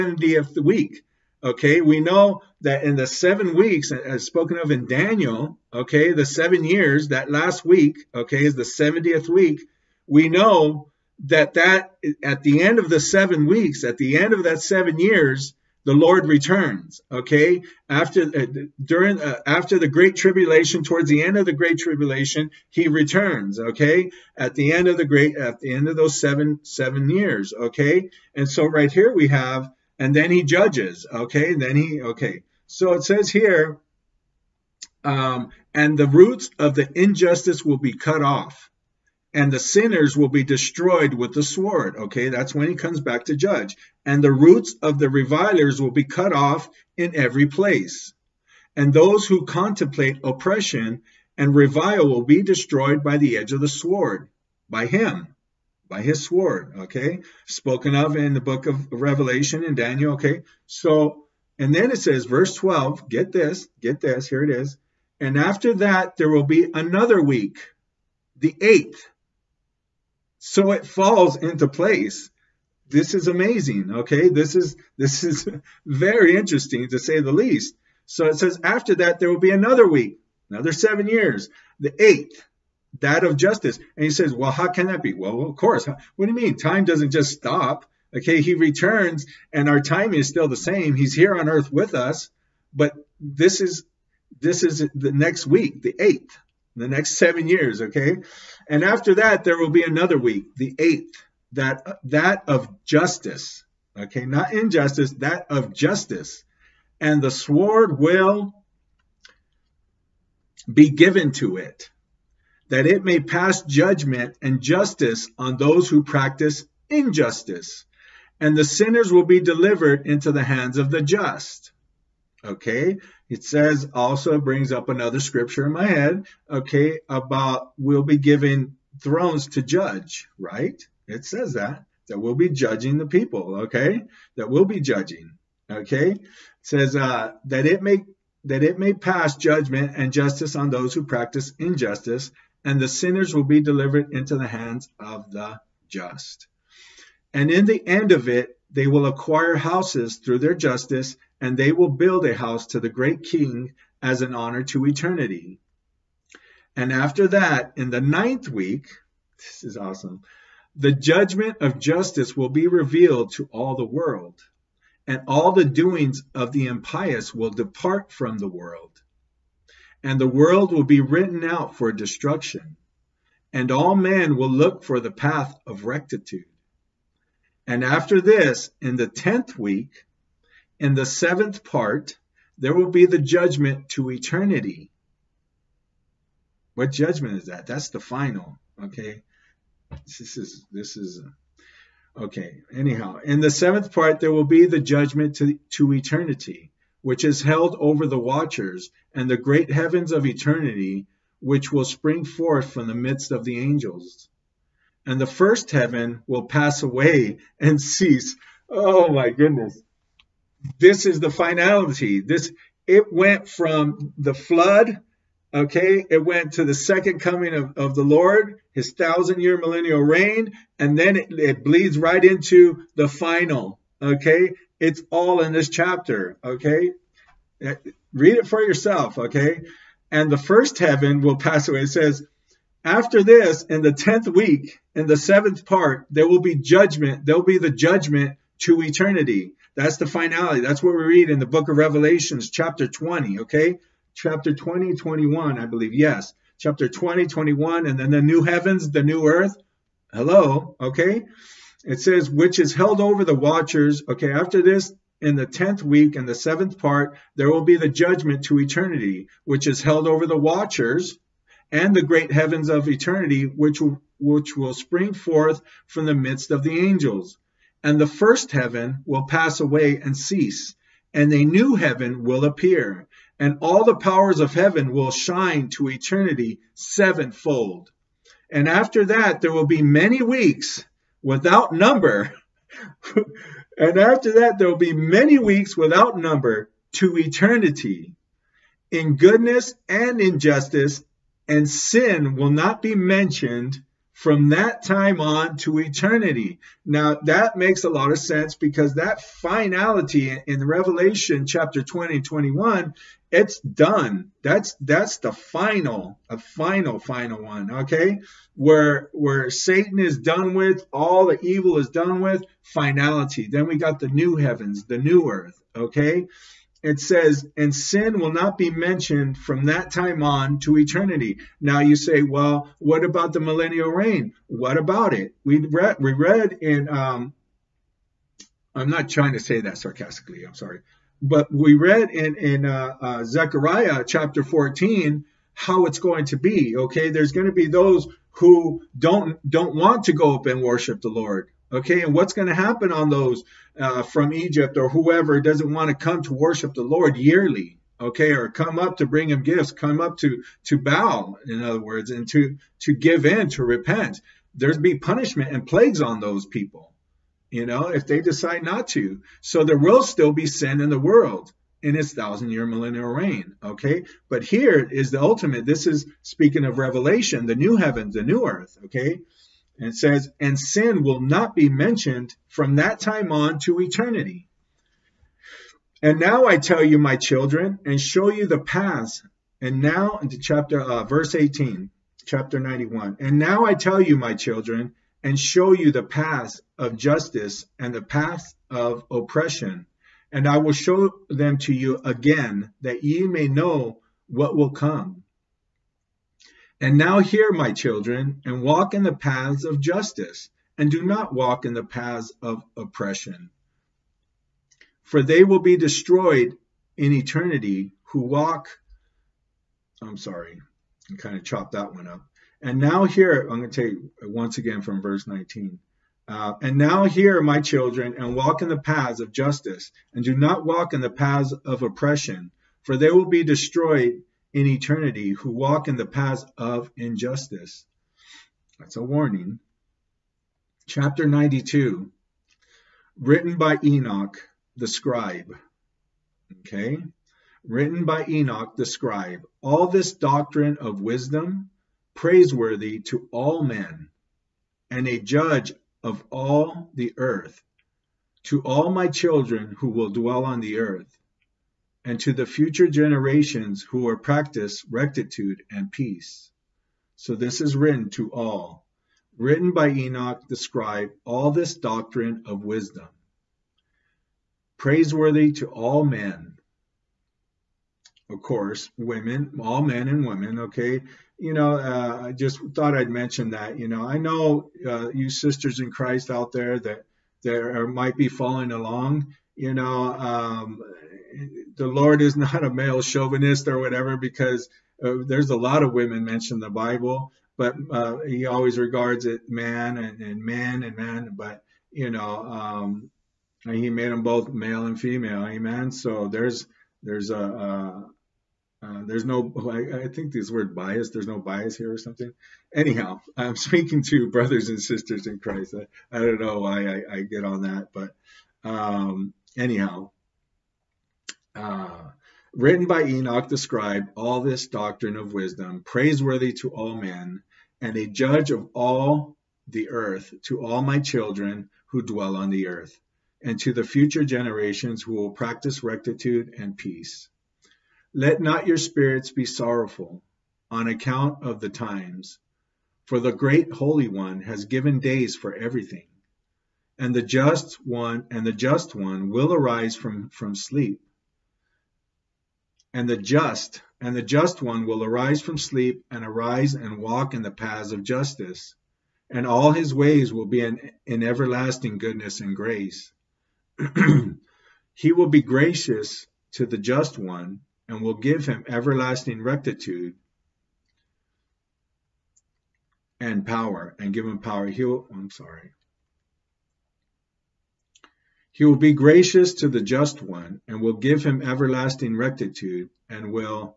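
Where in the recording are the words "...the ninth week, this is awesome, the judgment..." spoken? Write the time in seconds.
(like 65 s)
157 s.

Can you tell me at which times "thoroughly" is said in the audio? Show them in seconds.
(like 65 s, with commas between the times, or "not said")
not said.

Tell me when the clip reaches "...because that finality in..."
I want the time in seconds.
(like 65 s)
298 s.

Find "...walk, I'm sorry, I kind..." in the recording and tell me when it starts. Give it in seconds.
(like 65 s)
408 s.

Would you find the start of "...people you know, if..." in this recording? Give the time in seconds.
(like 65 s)
356 s.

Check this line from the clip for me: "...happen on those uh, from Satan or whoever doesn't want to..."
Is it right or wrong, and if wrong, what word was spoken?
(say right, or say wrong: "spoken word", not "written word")
wrong: "Egypt", not "Satan".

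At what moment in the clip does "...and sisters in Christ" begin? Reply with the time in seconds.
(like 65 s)
504 s.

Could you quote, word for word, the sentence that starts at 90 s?
He's here on earth with us, but this is this is the next week, the eighth, the next seven years, okay?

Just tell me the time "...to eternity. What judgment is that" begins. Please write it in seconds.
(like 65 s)
183 s.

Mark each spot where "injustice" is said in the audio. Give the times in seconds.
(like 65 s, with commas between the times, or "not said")
36 s, 104 s, 116 s, 141 s, 290 s, 426 s.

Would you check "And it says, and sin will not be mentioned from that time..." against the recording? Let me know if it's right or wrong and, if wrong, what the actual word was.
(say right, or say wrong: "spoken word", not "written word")
right.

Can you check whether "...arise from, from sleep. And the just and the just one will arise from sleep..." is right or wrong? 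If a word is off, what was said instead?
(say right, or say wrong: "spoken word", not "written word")
right.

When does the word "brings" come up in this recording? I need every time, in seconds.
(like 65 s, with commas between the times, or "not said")
124 s, 349 s.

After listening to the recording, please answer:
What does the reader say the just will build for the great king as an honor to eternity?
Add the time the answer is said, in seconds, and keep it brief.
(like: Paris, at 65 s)
a house, at 152 s.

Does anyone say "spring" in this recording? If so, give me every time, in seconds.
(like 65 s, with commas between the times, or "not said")
201 s, 264 s.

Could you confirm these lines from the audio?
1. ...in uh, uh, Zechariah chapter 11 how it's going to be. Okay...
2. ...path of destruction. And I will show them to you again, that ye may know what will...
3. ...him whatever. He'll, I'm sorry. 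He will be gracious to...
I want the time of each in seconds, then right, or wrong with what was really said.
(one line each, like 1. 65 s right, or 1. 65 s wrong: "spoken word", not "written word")
1. 332 s wrong: "14", not "11"
2. 388 s wrong: "oppression", not "destruction"
3. 564 s wrong: "power", not "whatever".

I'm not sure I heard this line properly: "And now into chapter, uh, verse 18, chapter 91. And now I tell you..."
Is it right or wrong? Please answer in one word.
right.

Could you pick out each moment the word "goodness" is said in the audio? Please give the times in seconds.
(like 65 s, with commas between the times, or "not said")
209 s, 289 s, 551 s.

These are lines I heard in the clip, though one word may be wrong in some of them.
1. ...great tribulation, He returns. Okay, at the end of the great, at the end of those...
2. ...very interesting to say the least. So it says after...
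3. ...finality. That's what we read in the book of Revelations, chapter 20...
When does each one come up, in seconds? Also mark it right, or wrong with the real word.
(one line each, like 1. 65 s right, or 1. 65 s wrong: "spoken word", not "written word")
1. 21 s right
2. 75 s right
3. 240 s right.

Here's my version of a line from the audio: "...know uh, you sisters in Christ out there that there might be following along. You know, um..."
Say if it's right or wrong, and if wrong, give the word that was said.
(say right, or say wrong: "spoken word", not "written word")
right.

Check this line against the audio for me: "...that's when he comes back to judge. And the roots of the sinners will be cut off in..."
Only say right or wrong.
wrong.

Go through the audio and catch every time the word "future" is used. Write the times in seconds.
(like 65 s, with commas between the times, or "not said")
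452 s, 523 s.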